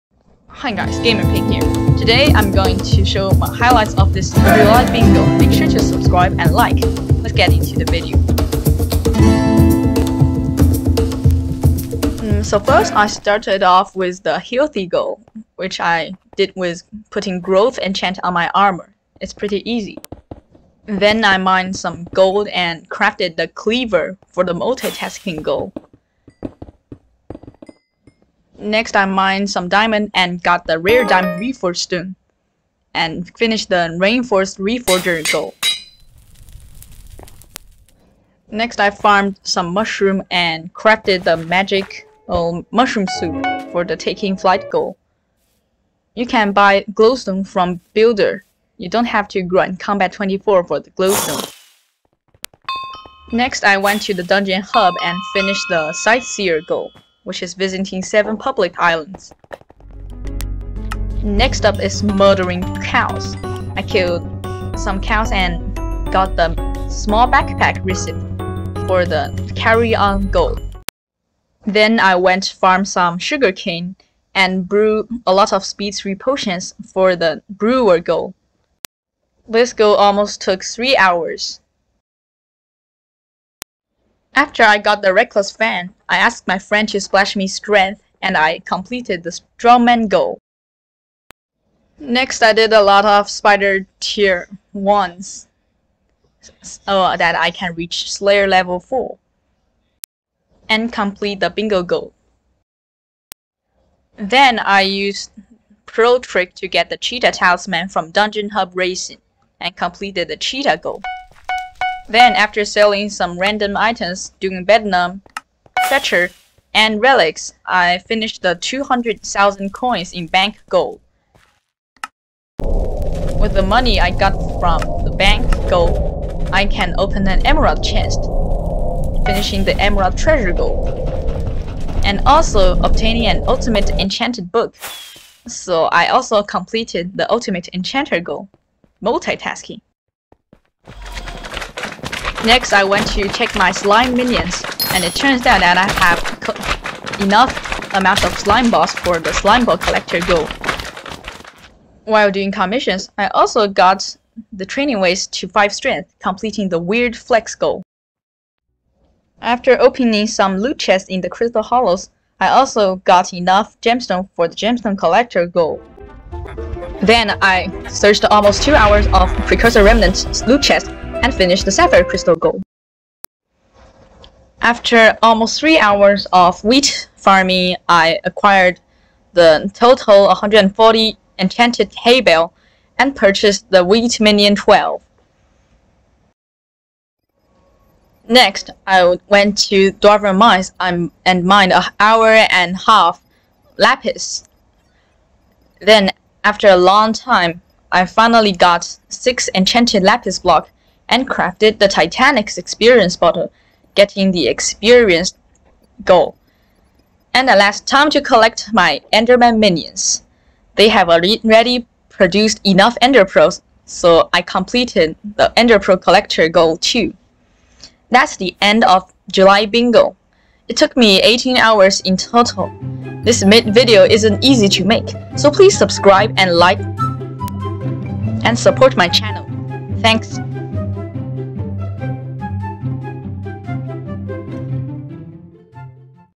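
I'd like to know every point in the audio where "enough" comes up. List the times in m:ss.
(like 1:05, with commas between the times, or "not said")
2:27, 2:43, 3:32.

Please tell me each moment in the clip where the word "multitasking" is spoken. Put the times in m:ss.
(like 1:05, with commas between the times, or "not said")
0:24, 2:19.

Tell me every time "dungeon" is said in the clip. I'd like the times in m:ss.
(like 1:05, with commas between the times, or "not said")
0:54, 1:48.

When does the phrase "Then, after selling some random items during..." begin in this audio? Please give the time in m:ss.
1:52.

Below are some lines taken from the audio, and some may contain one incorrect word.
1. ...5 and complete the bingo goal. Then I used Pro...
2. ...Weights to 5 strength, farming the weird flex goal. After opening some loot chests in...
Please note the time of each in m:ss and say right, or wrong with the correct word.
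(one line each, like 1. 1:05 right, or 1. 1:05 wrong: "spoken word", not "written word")
1. 1:38 wrong: "4", not "5"
2. 2:34 wrong: "completing", not "farming".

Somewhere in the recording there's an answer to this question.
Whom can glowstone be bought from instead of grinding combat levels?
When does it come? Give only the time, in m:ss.
0:47.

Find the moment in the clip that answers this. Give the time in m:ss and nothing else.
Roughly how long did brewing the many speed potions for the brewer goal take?
1:20.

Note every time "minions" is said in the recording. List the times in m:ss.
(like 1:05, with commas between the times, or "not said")
2:24, 3:04, 3:29.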